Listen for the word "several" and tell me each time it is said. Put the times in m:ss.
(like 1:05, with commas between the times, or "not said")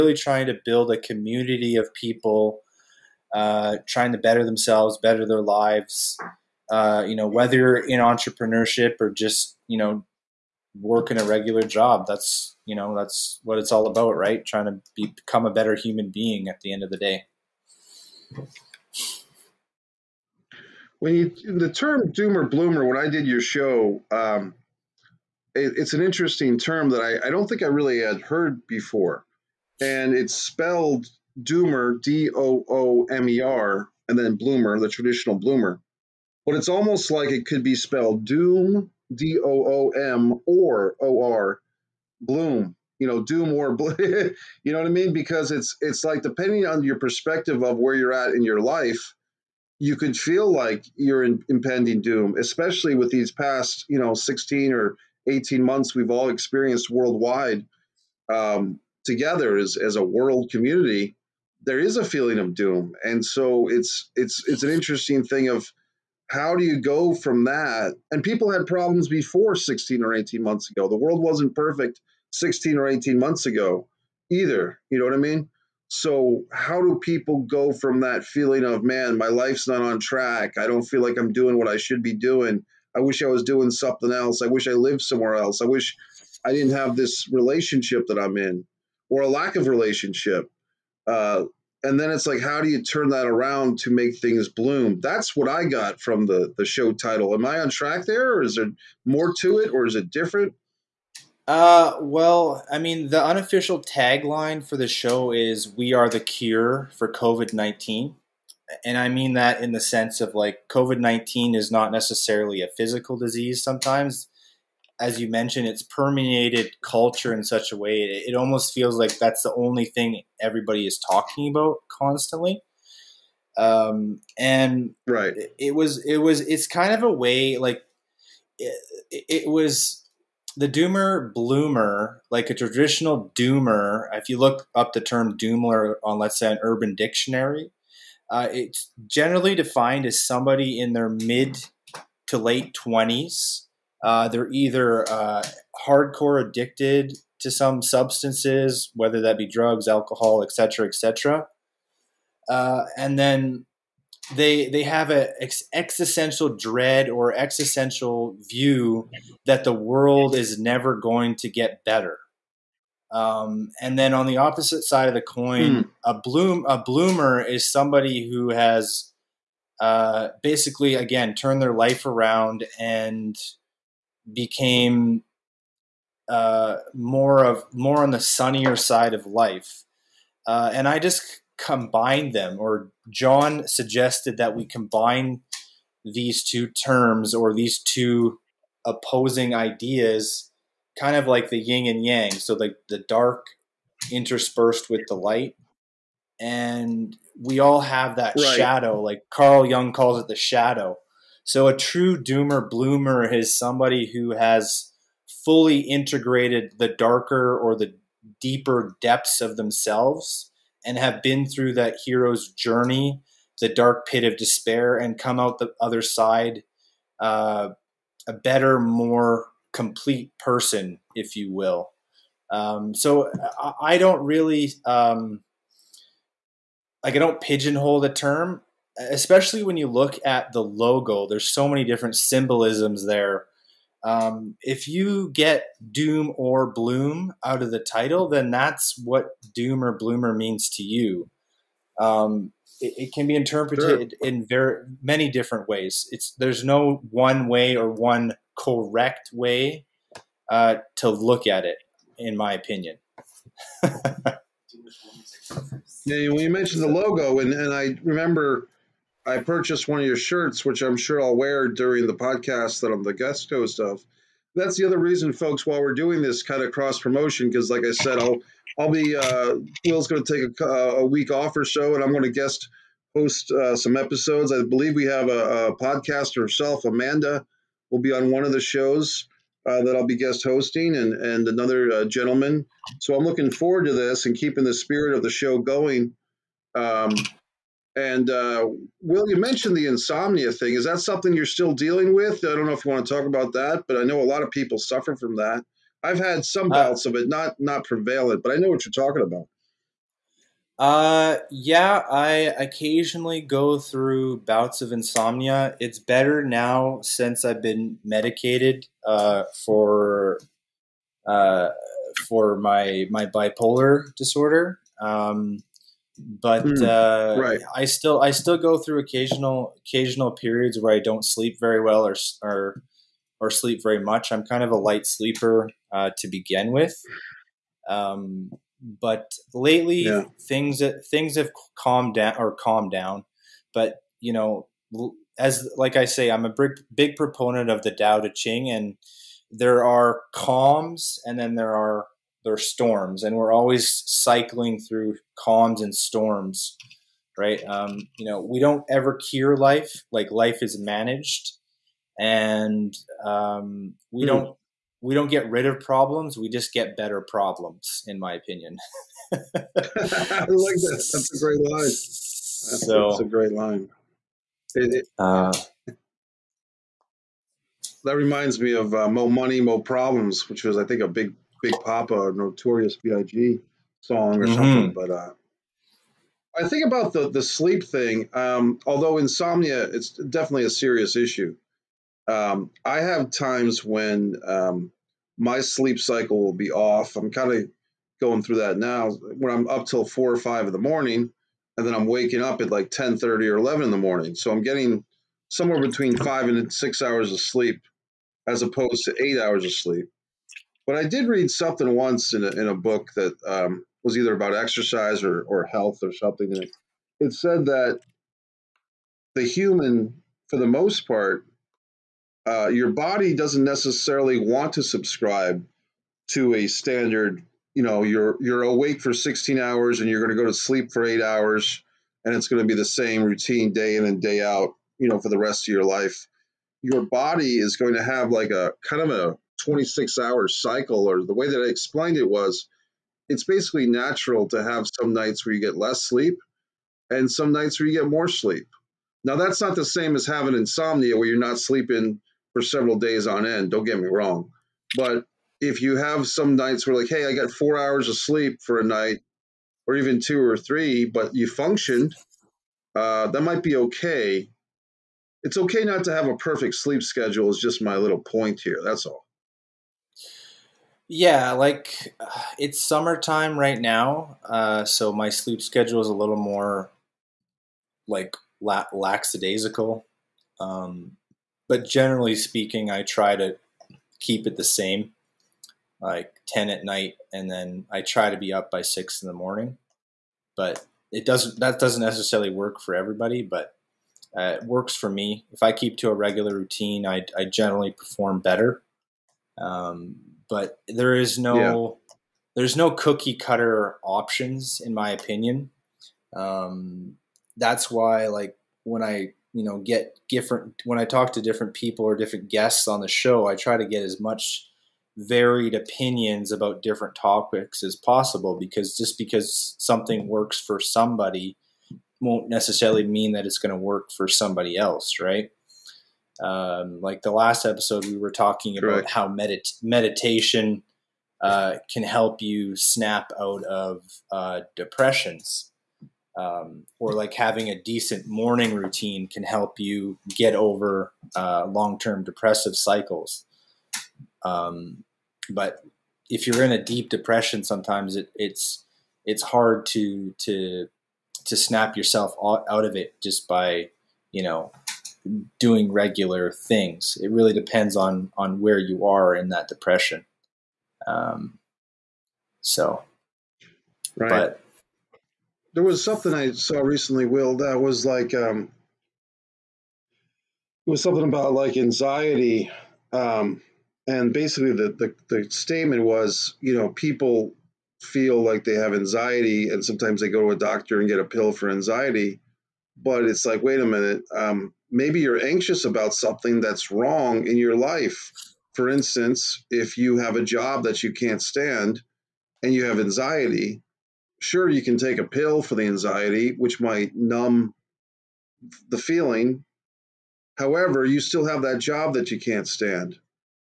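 7:22.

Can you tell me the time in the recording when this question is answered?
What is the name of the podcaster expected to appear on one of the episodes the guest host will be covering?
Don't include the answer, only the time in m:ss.
4:36.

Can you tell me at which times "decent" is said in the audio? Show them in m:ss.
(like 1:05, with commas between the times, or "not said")
8:47.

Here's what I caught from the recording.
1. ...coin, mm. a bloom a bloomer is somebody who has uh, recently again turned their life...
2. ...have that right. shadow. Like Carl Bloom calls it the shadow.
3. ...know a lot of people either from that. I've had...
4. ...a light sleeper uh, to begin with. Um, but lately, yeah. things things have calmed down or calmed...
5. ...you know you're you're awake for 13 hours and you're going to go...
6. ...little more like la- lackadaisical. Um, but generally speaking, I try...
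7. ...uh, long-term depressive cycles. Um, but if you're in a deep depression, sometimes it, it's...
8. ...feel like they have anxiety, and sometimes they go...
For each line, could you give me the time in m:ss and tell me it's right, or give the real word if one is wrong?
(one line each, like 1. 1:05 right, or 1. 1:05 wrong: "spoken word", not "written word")
1. 2:45 wrong: "basically", not "recently"
2. 3:17 wrong: "Jung", not "Bloom"
3. 4:54 wrong: "suffer", not "either"
4. 5:24 right
5. 6:57 wrong: "16", not "13"
6. 7:46 right
7. 8:51 right
8. 9:28 right.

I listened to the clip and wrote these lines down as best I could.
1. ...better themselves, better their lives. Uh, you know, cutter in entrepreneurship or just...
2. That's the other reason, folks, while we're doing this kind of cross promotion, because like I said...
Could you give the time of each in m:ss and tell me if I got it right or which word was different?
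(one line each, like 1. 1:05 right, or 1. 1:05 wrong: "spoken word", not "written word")
1. 0:04 wrong: "whether", not "cutter"
2. 4:24 right.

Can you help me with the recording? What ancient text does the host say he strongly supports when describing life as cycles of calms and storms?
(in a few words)
Tao Te Ching.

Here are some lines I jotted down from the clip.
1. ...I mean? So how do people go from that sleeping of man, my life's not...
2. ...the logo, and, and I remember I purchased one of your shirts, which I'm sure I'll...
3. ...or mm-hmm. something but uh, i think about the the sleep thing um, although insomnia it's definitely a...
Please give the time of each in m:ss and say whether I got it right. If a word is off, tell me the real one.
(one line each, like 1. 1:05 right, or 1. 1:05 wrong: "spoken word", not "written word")
1. 1:15 wrong: "feeling", not "sleeping"
2. 4:16 right
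3. 6:14 right.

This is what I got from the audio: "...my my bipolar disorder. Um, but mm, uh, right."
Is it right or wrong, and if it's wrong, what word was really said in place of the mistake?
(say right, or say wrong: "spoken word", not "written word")
right.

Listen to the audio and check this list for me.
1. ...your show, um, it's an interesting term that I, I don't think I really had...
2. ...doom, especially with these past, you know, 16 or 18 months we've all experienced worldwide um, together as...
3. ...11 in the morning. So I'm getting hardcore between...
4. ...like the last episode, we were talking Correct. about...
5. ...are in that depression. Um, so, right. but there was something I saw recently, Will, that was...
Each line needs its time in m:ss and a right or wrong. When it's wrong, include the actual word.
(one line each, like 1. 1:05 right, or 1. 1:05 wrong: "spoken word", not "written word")
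1. 0:23 right
2. 0:52 right
3. 6:33 wrong: "somewhere", not "hardcore"
4. 8:37 right
5. 9:09 right.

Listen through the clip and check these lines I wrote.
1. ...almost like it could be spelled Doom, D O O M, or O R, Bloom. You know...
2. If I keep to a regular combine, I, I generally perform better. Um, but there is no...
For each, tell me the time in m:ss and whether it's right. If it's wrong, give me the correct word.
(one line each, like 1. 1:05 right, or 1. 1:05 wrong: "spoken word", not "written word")
1. 0:36 right
2. 8:05 wrong: "routine", not "combine".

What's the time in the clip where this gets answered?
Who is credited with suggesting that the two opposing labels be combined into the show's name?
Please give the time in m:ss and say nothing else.
3:03.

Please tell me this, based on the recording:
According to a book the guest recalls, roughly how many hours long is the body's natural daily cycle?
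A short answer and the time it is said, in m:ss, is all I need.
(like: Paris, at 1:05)
26 hours, at 7:09.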